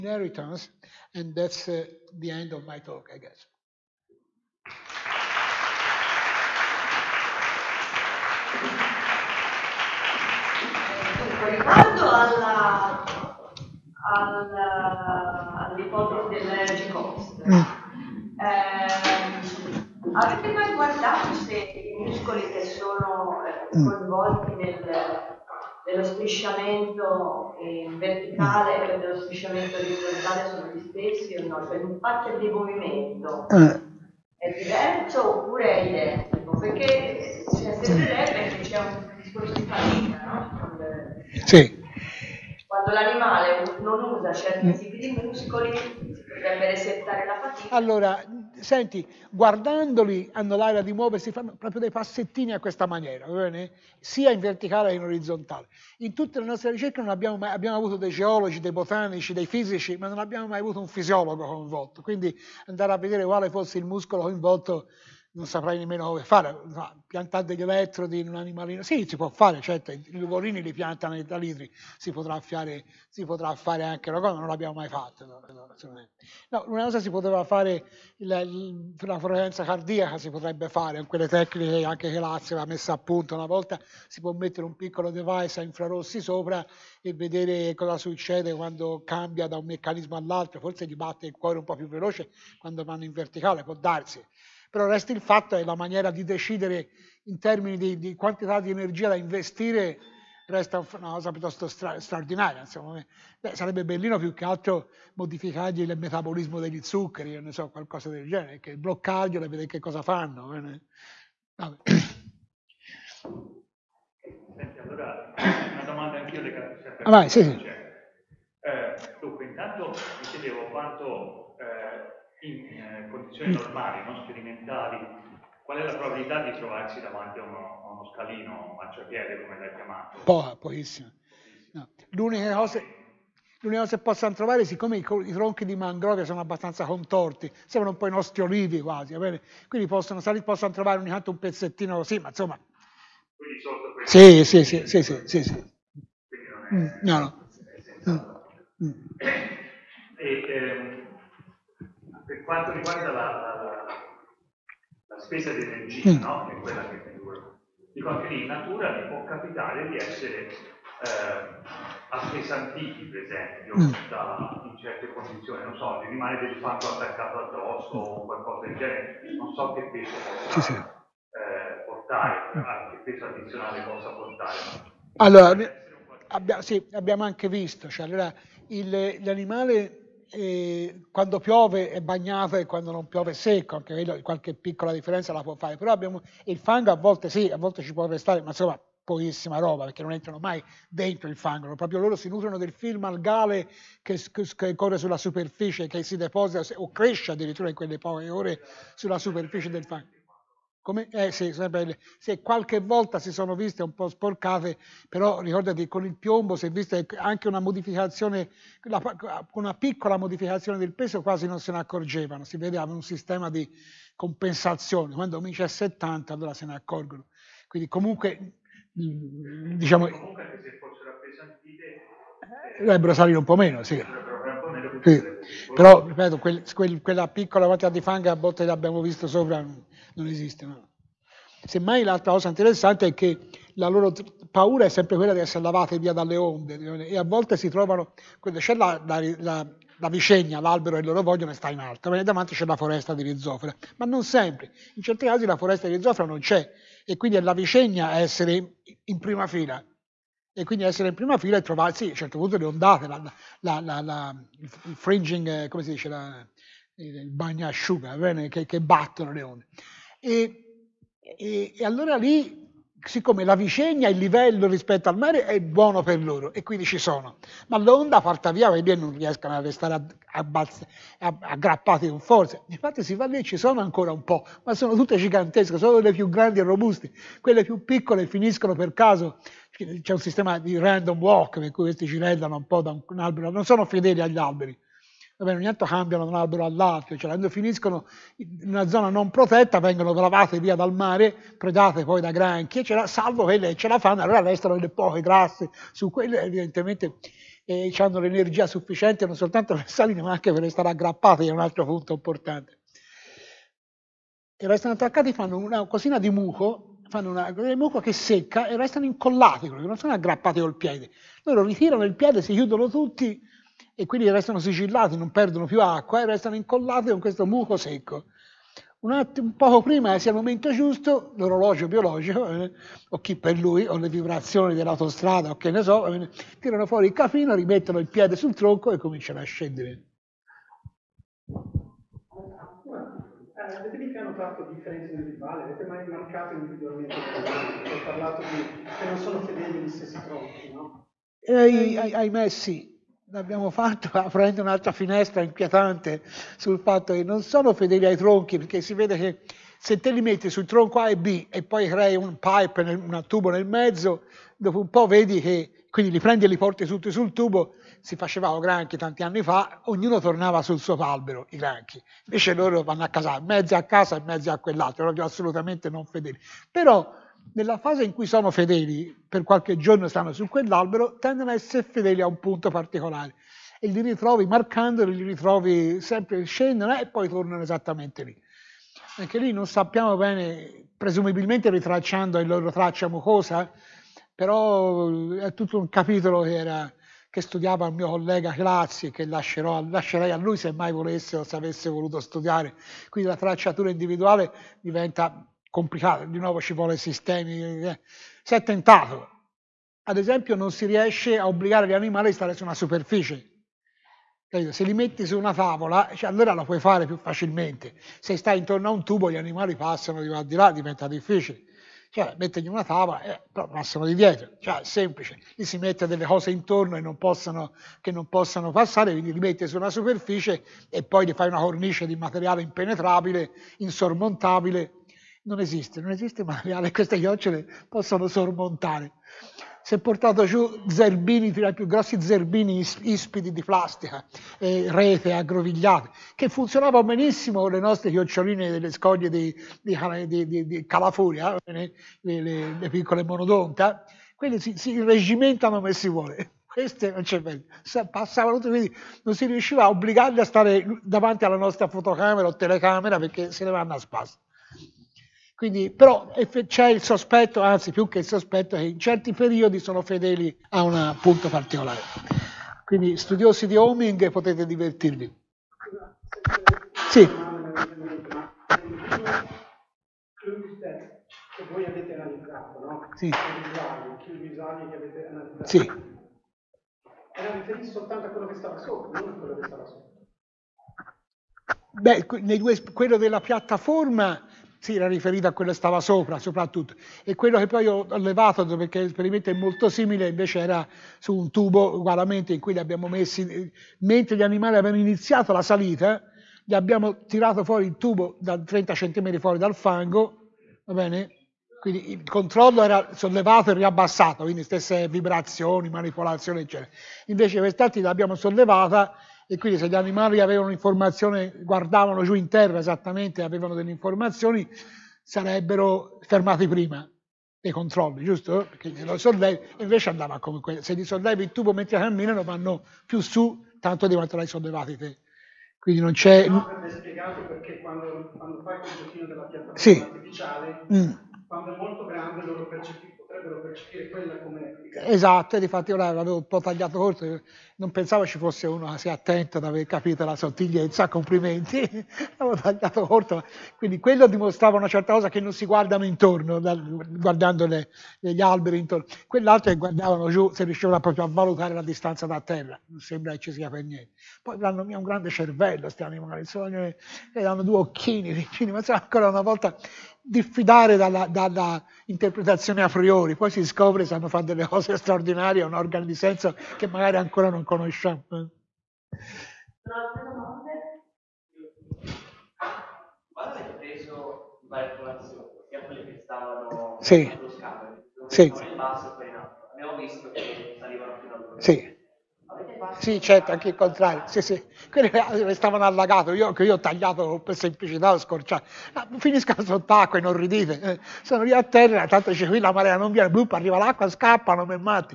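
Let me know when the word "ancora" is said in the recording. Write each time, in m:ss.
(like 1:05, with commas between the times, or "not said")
4:33, 9:18, 9:27.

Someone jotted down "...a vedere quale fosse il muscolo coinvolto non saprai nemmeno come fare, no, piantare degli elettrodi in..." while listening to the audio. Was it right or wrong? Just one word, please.
right.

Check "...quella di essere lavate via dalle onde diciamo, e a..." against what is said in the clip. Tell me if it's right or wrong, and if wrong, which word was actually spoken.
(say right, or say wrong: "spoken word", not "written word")
right.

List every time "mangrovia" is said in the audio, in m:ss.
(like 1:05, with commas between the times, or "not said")
2:15.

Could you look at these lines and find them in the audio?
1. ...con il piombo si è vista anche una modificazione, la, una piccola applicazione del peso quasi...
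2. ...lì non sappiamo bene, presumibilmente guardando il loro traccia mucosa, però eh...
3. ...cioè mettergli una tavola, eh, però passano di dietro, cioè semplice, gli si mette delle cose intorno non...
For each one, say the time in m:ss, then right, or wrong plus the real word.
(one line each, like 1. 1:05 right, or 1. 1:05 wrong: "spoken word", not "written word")
1. 3:25 wrong: "modificazione", not "applicazione"
2. 6:19 wrong: "ritracciando", not "guardando"
3. 6:52 right.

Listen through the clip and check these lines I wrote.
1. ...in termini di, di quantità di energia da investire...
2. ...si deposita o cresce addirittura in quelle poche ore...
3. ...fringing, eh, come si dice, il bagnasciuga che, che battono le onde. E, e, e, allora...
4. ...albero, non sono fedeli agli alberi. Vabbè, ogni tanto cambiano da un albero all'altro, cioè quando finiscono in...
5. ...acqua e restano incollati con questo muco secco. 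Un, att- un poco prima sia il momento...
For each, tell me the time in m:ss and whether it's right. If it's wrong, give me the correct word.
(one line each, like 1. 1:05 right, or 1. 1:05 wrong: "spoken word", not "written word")
1. 1:37 right
2. 3:16 right
3. 4:14 right
4. 4:43 right
5. 5:15 right.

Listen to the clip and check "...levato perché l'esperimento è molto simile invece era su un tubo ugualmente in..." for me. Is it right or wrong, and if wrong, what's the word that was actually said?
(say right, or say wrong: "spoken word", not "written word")
right.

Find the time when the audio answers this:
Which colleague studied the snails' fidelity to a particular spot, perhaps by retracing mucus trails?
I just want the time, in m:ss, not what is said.
6:28.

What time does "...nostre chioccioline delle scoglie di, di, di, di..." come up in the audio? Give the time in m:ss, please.
7:17.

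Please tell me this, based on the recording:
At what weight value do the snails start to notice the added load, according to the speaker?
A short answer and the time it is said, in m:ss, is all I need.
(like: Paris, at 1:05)
70, at 3:35.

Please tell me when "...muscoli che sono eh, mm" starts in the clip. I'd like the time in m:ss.
0:22.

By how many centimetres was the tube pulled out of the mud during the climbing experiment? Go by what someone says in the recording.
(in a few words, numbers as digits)
30 cm.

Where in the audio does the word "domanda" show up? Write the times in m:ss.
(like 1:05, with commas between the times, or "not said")
1:55.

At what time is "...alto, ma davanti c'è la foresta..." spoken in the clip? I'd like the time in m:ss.
4:01.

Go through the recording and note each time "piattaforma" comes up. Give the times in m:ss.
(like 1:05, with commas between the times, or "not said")
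8:03, 8:49.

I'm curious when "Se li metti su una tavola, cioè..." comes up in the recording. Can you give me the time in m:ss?
6:44.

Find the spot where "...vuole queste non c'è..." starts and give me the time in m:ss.
7:26.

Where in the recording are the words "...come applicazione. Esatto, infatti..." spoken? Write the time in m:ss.
8:54.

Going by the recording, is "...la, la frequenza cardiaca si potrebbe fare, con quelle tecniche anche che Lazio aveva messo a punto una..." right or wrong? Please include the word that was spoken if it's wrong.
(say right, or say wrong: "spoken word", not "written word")
right.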